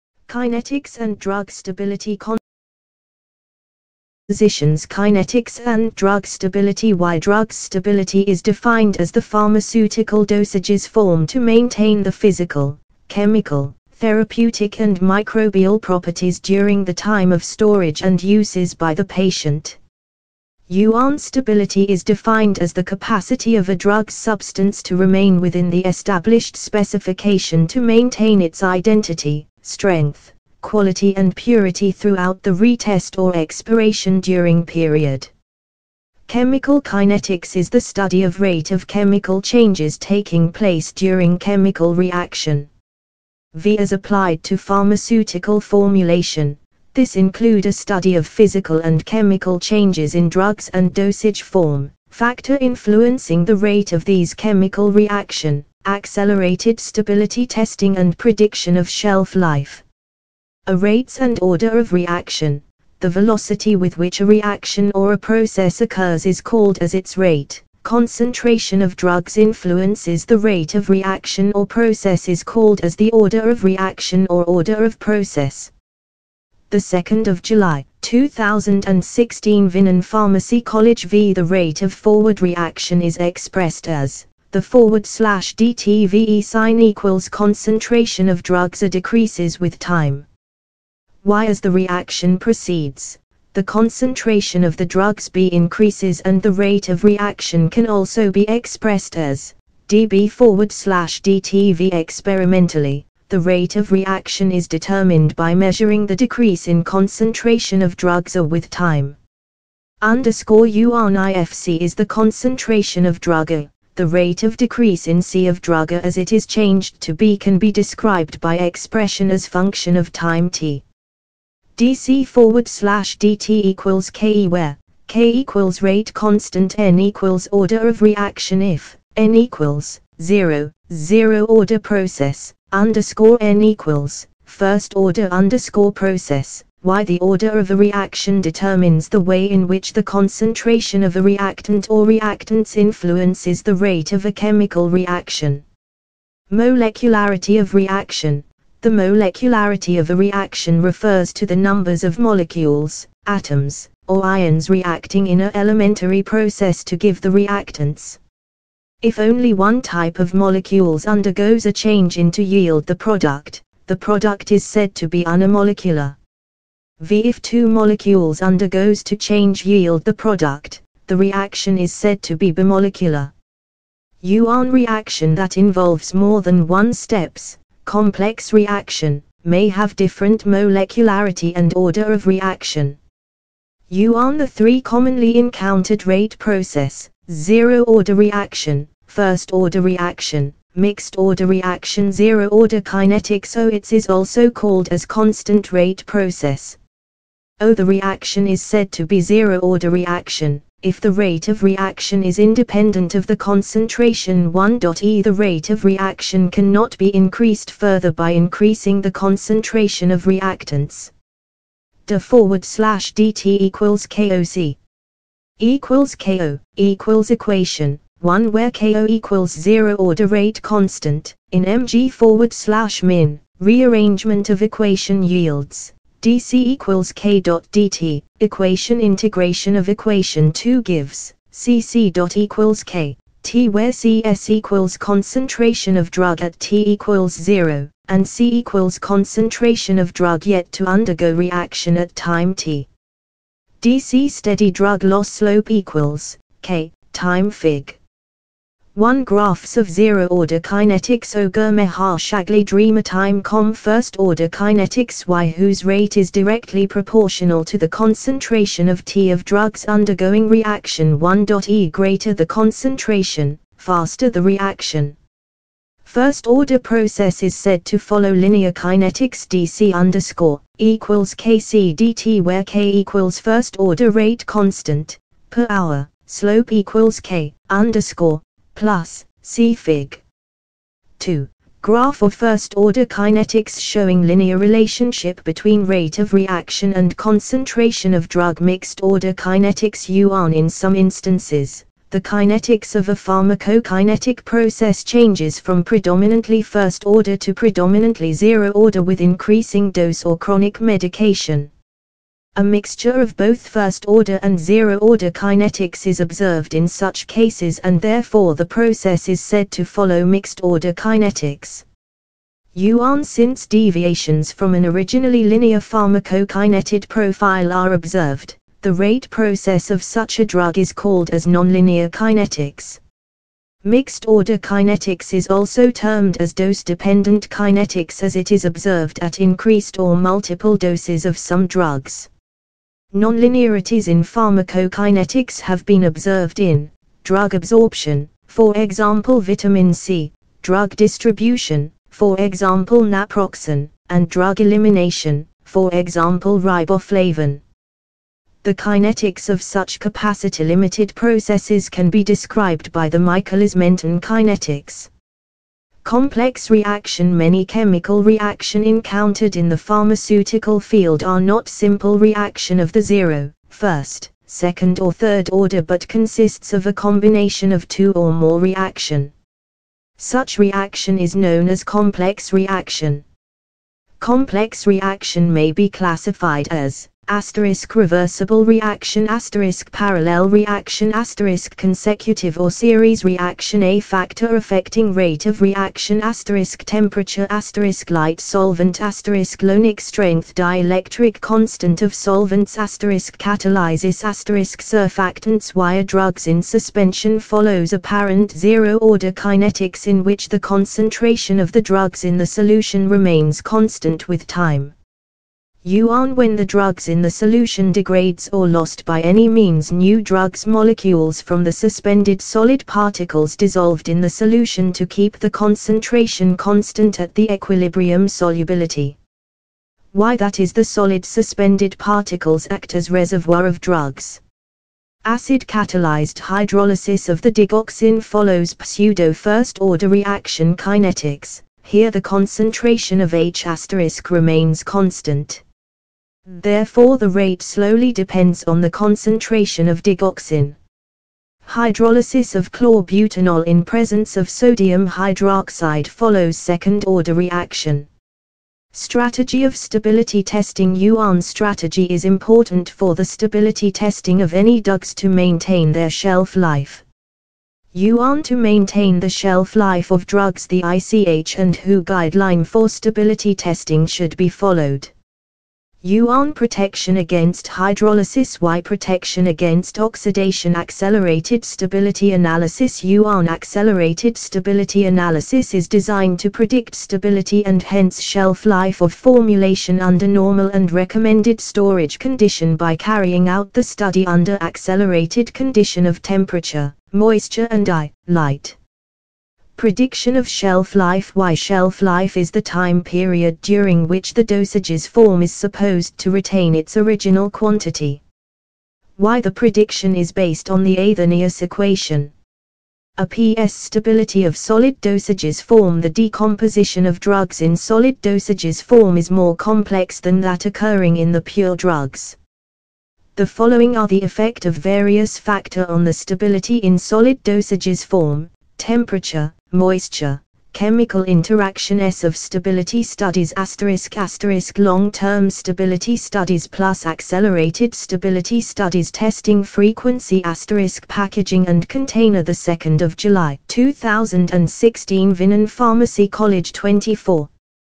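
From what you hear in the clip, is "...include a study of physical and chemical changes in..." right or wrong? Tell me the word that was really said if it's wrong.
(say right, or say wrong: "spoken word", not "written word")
right.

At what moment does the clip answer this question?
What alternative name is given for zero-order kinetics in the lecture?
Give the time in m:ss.
3:15.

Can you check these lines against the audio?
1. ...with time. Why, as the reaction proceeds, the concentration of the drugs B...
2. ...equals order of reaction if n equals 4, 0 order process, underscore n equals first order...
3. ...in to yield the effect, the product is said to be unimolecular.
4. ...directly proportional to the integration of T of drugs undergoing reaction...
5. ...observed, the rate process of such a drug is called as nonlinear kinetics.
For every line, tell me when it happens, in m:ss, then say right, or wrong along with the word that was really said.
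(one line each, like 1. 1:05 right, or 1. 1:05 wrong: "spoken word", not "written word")
1. 1:29 right
2. 2:06 wrong: "0", not "4"
3. 2:42 wrong: "product", not "effect"
4. 4:16 wrong: "concentration", not "integration"
5. 5:17 right.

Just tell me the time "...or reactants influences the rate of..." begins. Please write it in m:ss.
2:21.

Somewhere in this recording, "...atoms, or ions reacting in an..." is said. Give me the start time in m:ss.
2:33.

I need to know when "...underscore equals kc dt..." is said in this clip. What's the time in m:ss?
4:29.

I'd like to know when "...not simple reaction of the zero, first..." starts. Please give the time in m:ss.
6:01.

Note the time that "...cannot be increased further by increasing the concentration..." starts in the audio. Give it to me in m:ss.
3:26.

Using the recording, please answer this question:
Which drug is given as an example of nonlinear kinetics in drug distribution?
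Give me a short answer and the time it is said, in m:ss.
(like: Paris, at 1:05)
naproxen, at 5:43.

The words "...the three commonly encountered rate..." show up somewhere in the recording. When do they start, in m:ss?
3:04.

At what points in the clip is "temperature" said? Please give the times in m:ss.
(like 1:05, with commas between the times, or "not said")
6:26, 8:06, 8:38.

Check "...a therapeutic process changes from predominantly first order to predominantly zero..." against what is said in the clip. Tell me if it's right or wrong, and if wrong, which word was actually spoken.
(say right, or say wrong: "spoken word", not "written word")
wrong: "pharmacokinetic", not "therapeutic".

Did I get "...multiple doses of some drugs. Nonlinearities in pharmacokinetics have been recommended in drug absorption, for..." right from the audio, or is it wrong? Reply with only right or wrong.
wrong.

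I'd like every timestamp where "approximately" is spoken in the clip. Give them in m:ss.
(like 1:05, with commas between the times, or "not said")
not said.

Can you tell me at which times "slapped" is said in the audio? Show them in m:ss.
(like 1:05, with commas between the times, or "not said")
not said.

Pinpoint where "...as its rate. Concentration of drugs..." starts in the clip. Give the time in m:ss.
1:06.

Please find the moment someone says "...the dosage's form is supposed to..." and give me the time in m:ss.
8:14.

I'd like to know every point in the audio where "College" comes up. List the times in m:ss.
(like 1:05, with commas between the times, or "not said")
1:20, 8:56.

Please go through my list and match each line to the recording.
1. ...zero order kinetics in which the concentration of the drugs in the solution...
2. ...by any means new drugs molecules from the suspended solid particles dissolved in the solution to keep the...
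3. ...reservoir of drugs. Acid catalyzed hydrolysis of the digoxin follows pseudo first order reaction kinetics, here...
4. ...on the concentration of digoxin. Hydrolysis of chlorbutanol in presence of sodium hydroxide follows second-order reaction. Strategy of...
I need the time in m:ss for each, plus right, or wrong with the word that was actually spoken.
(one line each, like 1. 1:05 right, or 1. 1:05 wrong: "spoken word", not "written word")
1. 6:38 right
2. 6:49 right
3. 7:03 right
4. 7:18 right.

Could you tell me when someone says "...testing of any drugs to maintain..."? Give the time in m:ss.
7:33.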